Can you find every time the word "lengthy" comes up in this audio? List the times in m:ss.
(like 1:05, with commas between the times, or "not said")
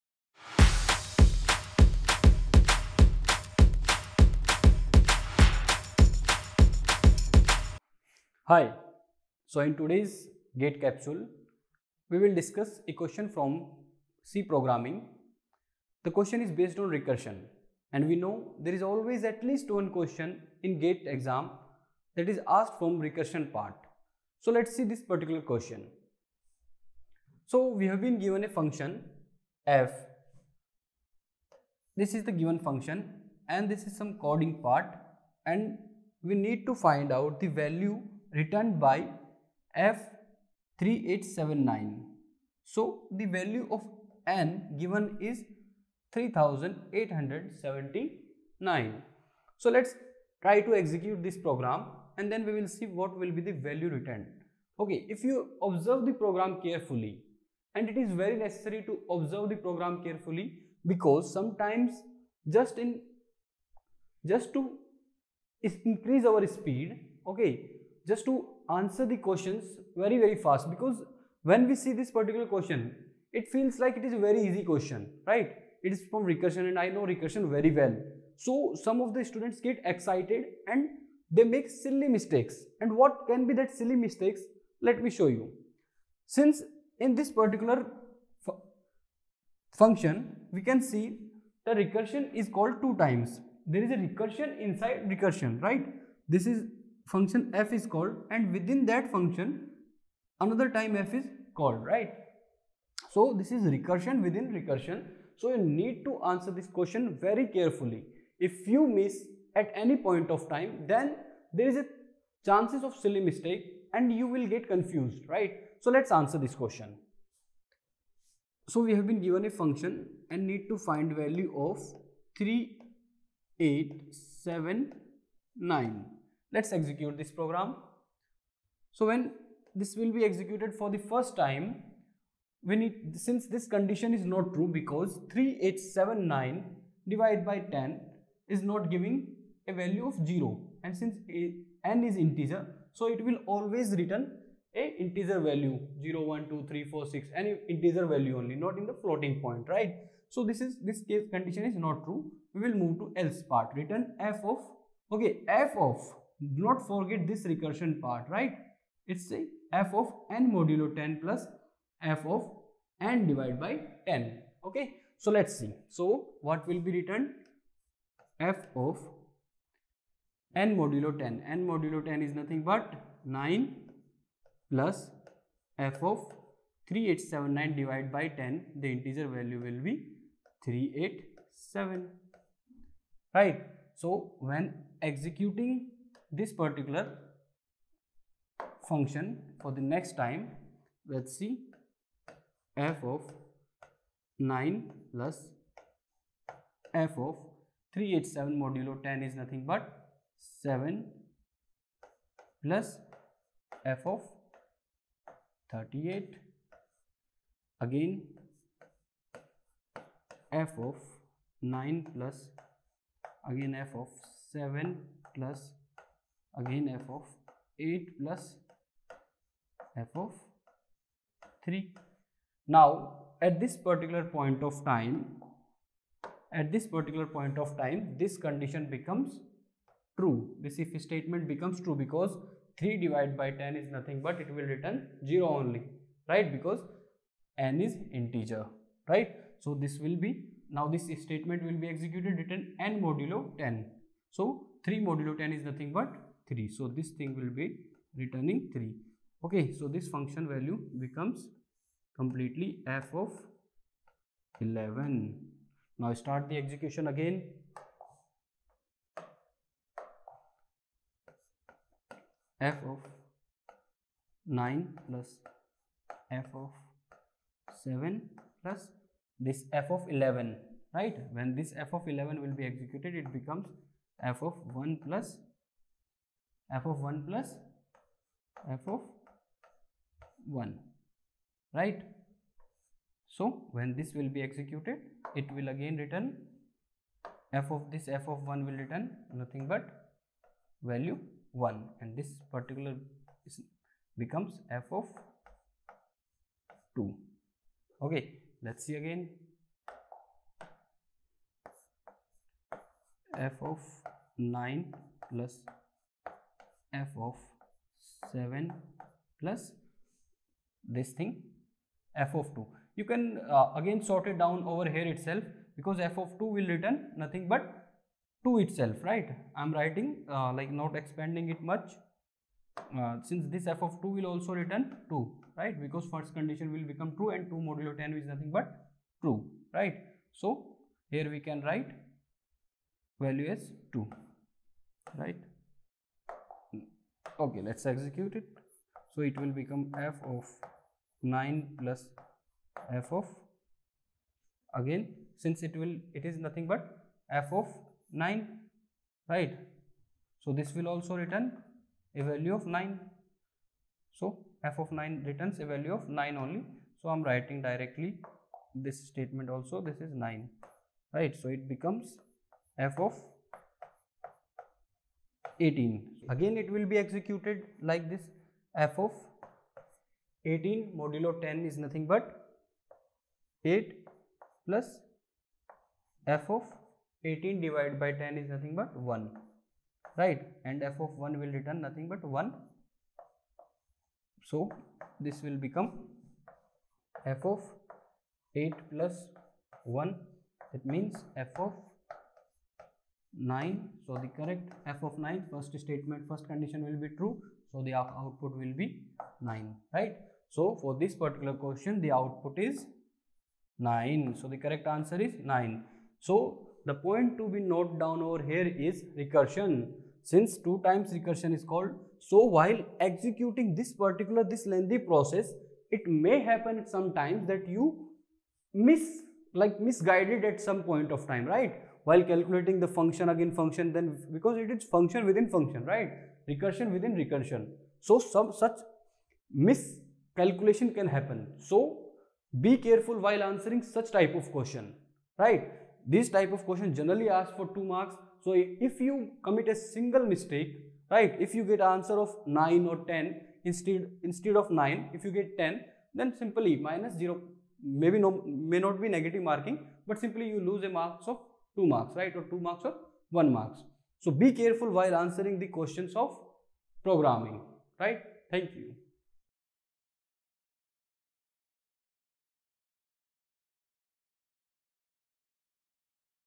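6:54.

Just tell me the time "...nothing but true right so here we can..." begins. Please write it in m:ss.
5:28.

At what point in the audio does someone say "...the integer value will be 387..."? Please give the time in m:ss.
2:58.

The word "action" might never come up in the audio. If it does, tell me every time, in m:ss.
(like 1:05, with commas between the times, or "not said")
not said.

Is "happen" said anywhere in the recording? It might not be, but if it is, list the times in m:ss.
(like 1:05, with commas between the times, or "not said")
6:56, 7:11.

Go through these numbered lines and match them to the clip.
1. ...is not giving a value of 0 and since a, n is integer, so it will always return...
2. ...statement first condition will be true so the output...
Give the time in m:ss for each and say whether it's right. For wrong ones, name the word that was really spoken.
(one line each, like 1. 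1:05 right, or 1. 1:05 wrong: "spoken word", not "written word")
1. 2:18 right
2. 6:35 right.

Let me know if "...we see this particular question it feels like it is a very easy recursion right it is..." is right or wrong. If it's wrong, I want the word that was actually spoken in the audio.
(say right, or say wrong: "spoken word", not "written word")
wrong: "question", not "recursion".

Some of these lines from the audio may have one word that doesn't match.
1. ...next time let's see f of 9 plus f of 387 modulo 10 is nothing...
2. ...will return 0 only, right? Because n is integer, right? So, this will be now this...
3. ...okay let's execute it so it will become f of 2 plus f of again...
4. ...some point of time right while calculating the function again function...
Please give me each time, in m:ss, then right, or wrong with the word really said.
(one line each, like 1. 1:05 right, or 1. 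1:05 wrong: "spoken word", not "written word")
1. 3:09 right
2. 3:54 right
3. 5:37 wrong: "9", not "2"
4. 7:00 right.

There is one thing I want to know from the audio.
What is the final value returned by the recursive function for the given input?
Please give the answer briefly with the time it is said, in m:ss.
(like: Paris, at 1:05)
9, at 6:44.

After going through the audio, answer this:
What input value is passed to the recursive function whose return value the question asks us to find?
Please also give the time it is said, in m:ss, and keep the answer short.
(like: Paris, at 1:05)
3879, at 0:39.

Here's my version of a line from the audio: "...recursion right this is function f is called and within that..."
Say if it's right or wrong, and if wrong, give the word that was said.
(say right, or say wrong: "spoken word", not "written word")
right.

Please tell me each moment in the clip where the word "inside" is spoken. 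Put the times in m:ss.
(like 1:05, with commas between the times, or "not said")
1:34.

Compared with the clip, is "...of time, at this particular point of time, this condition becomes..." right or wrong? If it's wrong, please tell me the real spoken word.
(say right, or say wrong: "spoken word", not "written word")
right.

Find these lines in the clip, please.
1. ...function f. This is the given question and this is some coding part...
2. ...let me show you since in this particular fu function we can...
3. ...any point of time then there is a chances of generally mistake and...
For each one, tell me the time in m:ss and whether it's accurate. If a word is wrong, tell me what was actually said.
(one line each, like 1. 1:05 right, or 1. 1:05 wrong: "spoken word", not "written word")
1. 0:28 wrong: "function", not "question"
2. 1:24 right
3. 1:49 wrong: "silly", not "generally".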